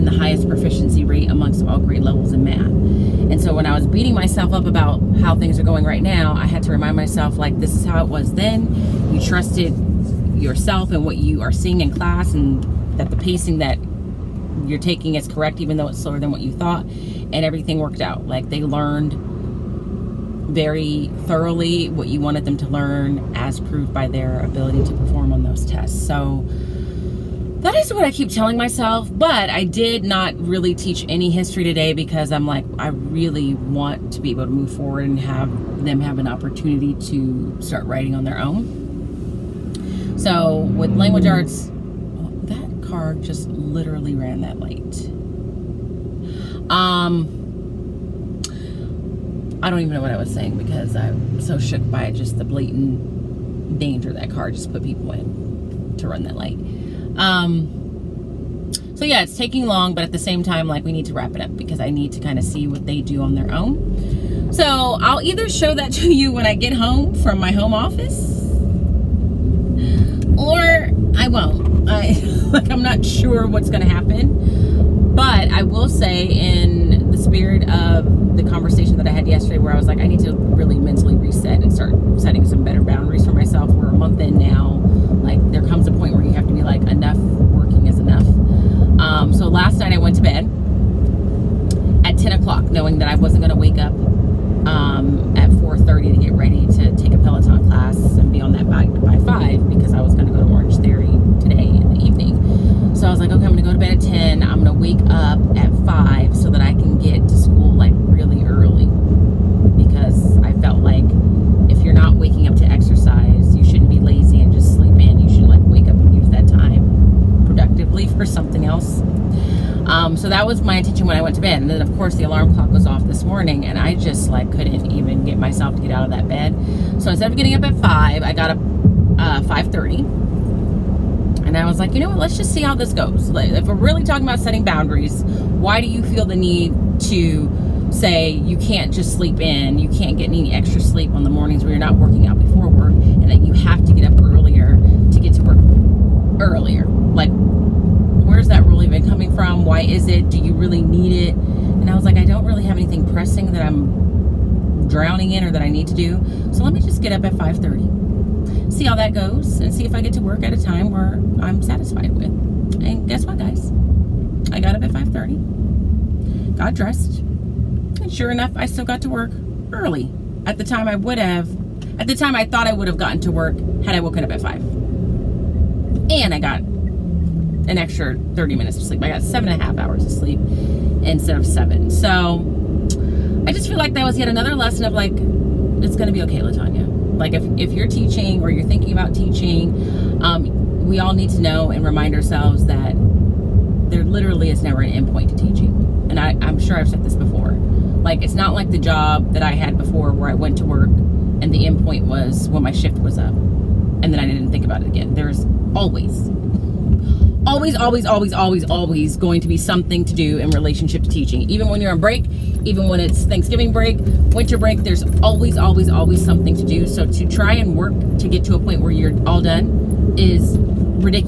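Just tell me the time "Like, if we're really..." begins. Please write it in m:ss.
2:13.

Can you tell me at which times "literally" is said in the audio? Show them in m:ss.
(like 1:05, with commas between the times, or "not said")
0:43, 3:14.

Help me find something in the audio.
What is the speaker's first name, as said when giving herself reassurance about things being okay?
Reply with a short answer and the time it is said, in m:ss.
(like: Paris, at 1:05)
Latawnya, at 3:06.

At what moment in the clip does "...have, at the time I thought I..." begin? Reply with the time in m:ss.
2:51.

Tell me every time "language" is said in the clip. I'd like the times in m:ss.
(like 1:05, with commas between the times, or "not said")
0:40.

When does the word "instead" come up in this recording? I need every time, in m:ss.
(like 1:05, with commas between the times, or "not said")
2:07, 3:01.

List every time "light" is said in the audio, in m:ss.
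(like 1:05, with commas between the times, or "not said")
0:44, 0:56.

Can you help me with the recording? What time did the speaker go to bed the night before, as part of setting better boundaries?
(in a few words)
10 o'clock.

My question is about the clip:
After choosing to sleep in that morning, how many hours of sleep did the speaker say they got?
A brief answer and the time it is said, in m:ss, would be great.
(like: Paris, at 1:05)
7.5, at 2:59.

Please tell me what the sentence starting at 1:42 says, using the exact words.
So I was like, okay, I'm going to go to bed at 10.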